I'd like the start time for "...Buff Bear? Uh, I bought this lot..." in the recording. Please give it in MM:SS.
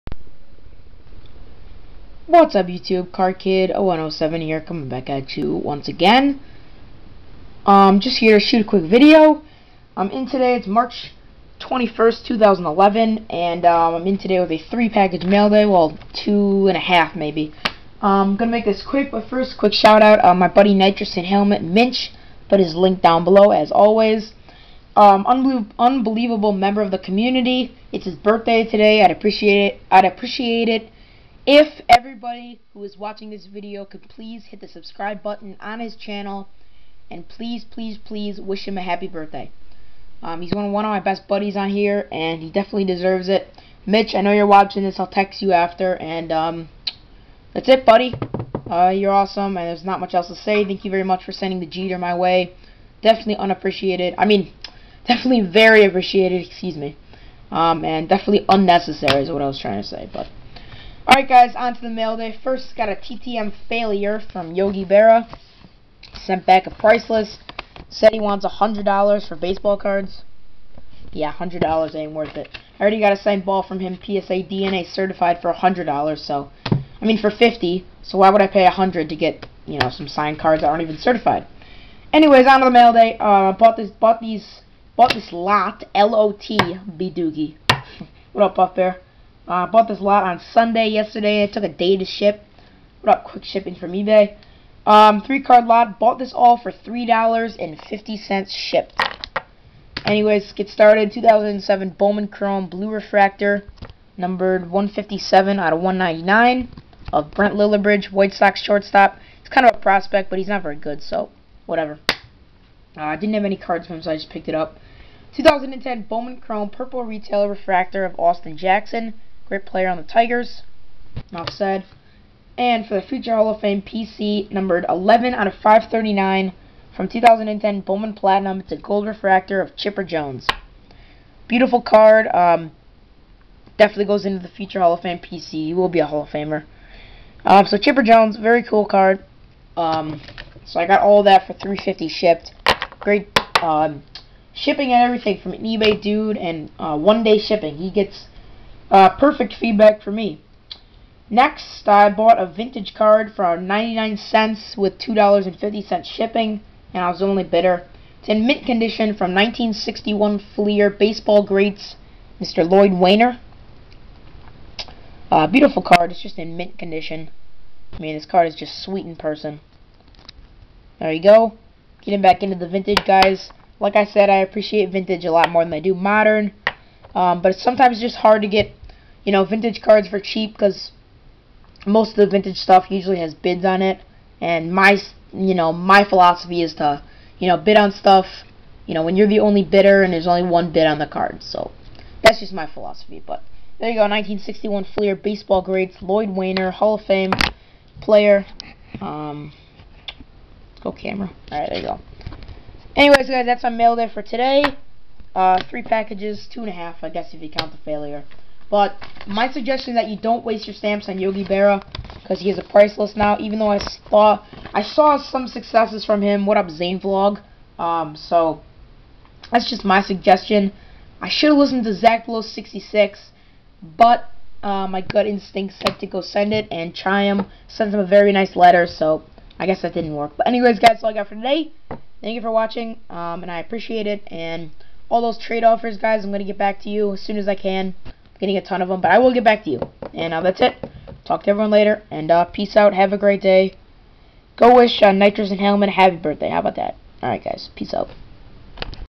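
01:28.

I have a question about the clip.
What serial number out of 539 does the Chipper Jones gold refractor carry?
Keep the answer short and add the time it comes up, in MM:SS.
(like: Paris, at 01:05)
11, at 02:04.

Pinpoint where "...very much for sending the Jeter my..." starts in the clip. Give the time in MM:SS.
00:50.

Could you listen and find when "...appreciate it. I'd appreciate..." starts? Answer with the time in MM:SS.
00:29.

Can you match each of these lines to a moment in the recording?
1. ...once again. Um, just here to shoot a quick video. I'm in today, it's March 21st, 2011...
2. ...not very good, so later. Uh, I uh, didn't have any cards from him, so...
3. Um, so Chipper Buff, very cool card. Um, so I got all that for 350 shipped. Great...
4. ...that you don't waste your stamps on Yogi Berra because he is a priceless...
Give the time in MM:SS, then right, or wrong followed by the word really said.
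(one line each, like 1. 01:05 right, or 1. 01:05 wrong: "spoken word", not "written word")
1. 00:05 right
2. 01:50 wrong: "whatever", not "later"
3. 02:17 wrong: "Jones", not "Buff"
4. 03:29 right.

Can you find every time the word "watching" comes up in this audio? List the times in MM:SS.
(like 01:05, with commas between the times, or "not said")
00:32, 00:44, 03:52.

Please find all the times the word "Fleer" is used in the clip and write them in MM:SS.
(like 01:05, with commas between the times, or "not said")
02:40, 03:14.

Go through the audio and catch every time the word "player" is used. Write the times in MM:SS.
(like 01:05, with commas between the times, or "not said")
01:59, 03:18.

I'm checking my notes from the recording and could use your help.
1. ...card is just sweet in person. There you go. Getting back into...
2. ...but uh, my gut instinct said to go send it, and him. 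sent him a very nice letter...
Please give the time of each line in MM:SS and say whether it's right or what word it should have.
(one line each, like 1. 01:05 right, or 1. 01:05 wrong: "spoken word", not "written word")
1. 02:48 right
2. 03:43 right.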